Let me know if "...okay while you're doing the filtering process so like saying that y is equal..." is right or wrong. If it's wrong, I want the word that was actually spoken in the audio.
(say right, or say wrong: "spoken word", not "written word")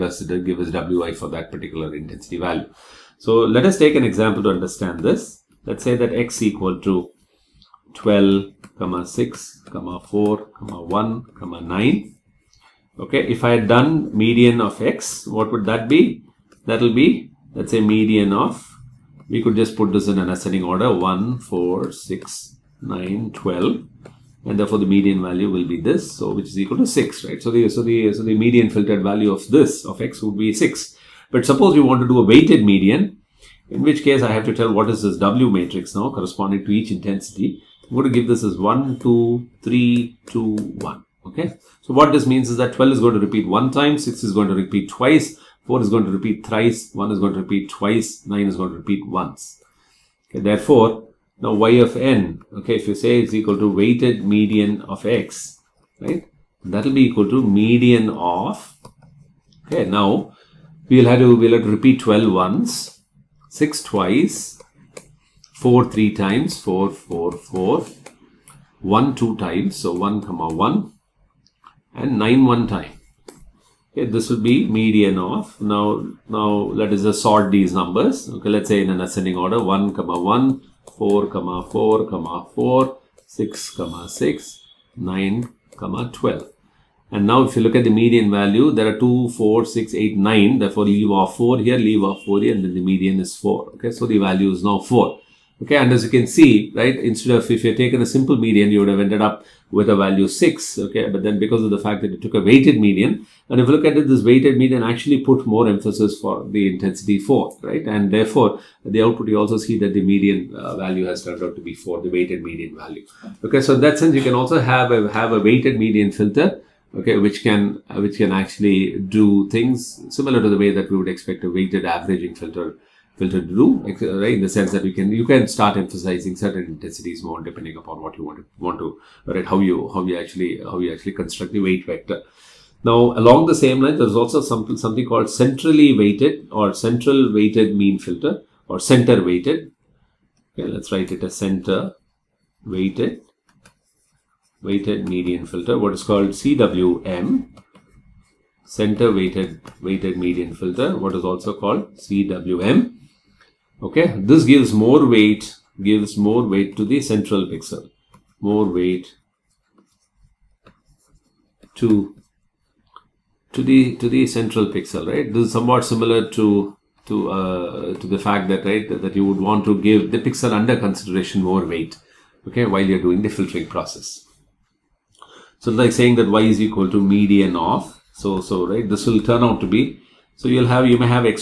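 right.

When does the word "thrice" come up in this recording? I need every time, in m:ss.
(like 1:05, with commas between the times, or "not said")
0:46.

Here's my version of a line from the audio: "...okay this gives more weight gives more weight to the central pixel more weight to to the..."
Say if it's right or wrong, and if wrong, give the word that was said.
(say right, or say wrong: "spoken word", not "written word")
right.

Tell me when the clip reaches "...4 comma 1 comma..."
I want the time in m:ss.
0:09.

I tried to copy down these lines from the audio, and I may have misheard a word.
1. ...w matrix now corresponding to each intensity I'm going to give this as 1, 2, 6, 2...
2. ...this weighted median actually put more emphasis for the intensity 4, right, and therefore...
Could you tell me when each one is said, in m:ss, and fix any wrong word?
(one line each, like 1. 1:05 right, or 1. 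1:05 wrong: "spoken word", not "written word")
1. 0:35 wrong: "3", not "6"
2. 1:44 right.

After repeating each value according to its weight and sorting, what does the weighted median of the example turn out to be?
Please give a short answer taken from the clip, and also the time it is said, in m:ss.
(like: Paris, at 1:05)
4, at 1:32.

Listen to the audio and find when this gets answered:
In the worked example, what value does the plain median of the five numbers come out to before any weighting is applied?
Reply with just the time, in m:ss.
0:26.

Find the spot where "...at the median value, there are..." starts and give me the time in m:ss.
1:27.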